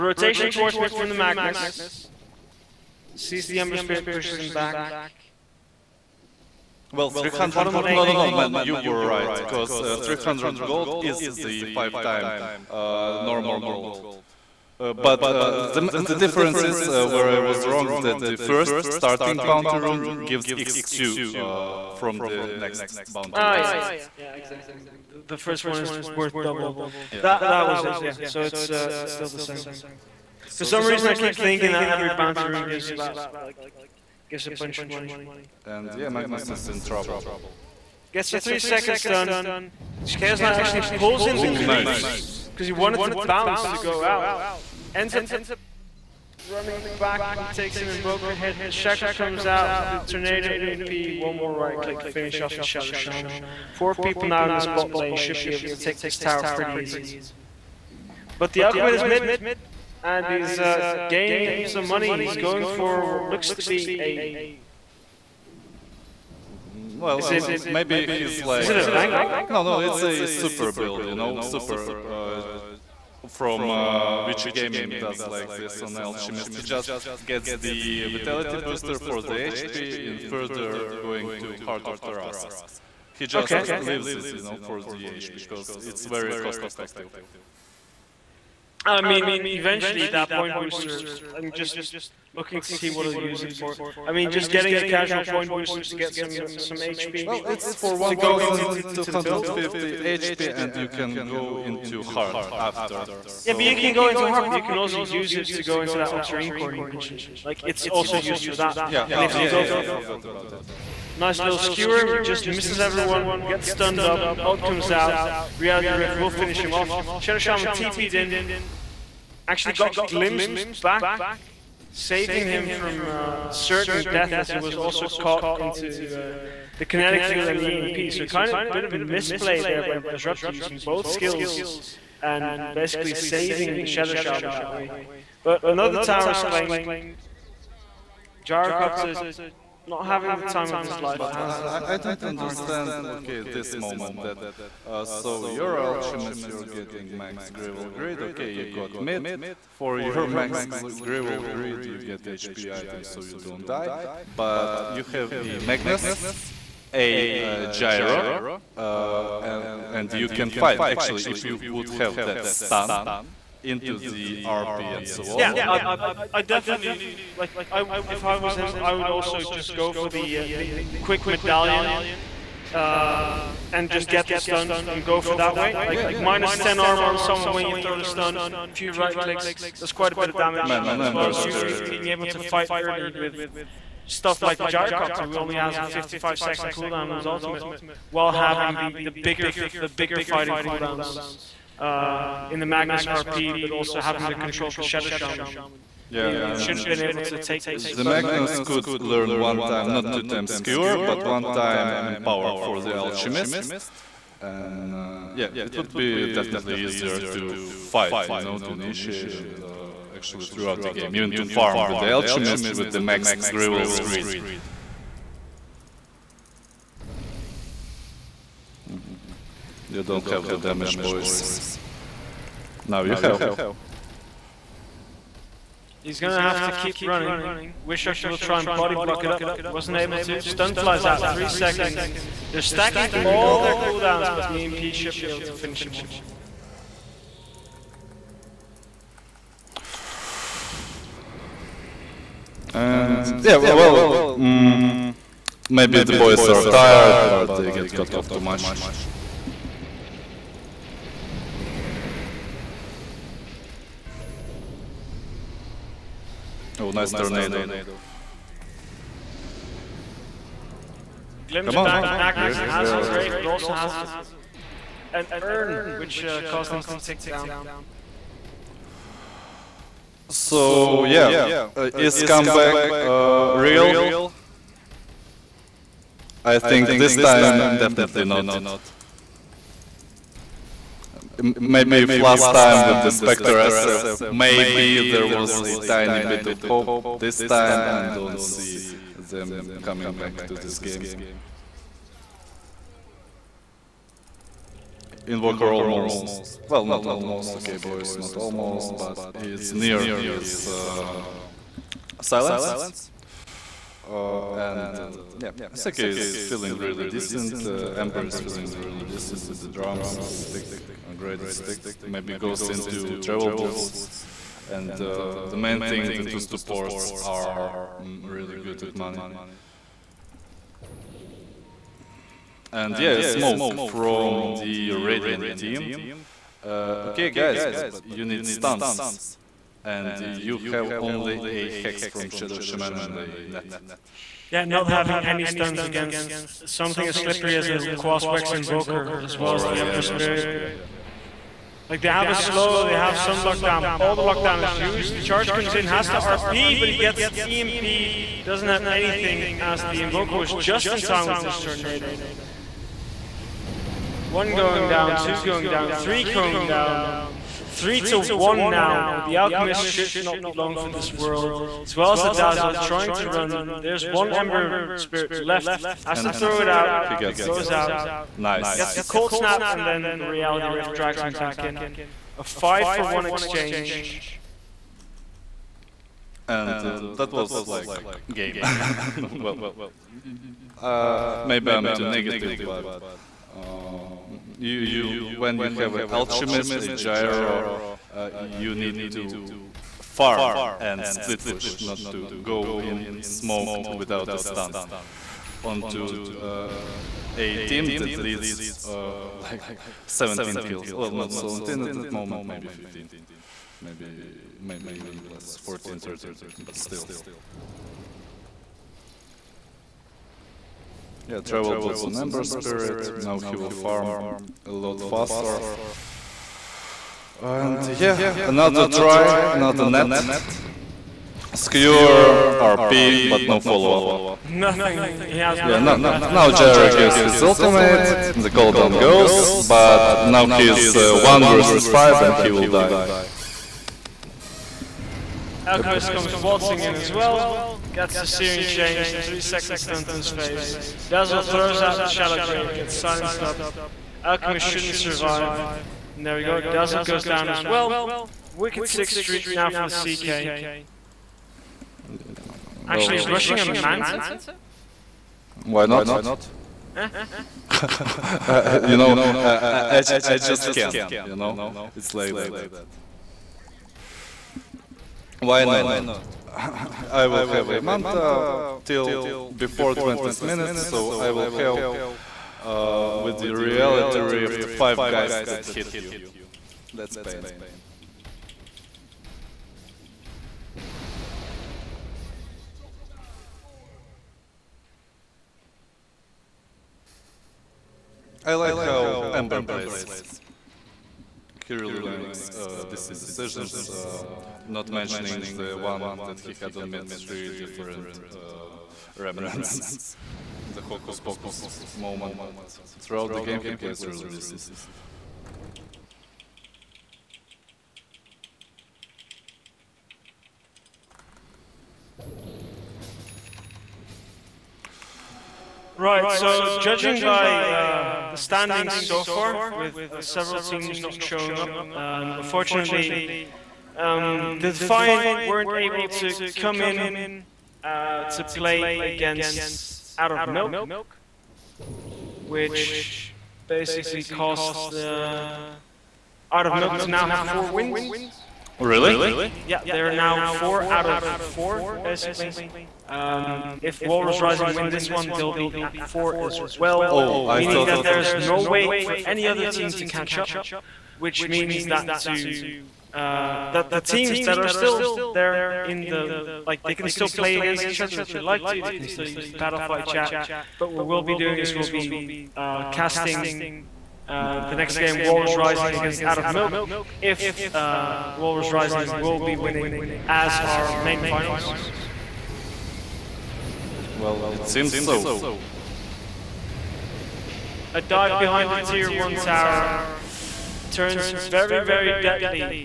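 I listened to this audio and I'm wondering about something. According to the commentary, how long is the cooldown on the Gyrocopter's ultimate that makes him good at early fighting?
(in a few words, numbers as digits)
55 seconds.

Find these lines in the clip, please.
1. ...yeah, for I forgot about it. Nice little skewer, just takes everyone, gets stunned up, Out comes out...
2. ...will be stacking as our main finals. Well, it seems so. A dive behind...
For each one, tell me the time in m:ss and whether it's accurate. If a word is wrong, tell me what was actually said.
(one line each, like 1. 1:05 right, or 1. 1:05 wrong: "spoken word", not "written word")
1. 1:49 wrong: "misses", not "takes"
2. 9:29 wrong: "winning", not "stacking".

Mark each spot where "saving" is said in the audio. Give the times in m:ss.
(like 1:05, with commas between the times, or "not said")
2:01, 2:13.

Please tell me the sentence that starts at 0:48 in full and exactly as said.
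The Shackle comes out with the Tornado EMP.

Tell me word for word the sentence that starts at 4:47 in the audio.
This time I don't see them coming back to this game.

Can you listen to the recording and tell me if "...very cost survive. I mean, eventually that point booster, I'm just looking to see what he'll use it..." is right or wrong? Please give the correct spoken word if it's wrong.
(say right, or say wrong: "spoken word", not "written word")
wrong: "effective", not "survive".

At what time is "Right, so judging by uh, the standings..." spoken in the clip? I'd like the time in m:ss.
8:36.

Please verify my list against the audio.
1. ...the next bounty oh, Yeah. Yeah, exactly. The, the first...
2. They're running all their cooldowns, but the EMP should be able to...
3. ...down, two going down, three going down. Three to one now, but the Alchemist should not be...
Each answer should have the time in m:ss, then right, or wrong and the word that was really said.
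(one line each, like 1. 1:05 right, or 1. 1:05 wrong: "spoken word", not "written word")
1. 0:22 right
2. 3:52 wrong: "stacking", not "running"
3. 5:54 right.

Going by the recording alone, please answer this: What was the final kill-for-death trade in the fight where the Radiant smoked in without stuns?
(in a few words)
Five for one.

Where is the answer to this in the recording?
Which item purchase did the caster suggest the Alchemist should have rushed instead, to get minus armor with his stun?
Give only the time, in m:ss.
2:51.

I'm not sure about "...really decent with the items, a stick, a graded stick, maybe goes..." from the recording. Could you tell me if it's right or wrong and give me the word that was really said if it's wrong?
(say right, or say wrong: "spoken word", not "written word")
wrong: "drums", not "items".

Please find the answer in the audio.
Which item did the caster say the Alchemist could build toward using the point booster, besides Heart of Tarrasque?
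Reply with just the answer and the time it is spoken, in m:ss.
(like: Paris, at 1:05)
Octarine Core, at 1:46.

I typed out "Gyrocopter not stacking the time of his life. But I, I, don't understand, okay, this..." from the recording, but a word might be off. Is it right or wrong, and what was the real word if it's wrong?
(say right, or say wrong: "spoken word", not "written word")
wrong: "having", not "stacking".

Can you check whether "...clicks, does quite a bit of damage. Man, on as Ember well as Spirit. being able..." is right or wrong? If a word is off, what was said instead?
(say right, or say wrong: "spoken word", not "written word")
right.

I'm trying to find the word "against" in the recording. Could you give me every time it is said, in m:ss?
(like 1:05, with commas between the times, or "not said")
5:35, 8:49, 9:17, 9:25.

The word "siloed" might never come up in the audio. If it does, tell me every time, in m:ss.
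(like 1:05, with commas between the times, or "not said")
not said.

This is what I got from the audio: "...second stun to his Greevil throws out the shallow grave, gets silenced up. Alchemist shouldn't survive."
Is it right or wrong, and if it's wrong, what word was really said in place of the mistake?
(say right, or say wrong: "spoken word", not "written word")
wrong: "Dazzle", not "Greevil".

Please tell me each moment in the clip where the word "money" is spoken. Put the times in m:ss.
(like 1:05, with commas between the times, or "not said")
0:34, 1:01, 5:18.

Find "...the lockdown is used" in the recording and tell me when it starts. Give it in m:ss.
5:44.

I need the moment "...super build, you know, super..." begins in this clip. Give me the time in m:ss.
1:10.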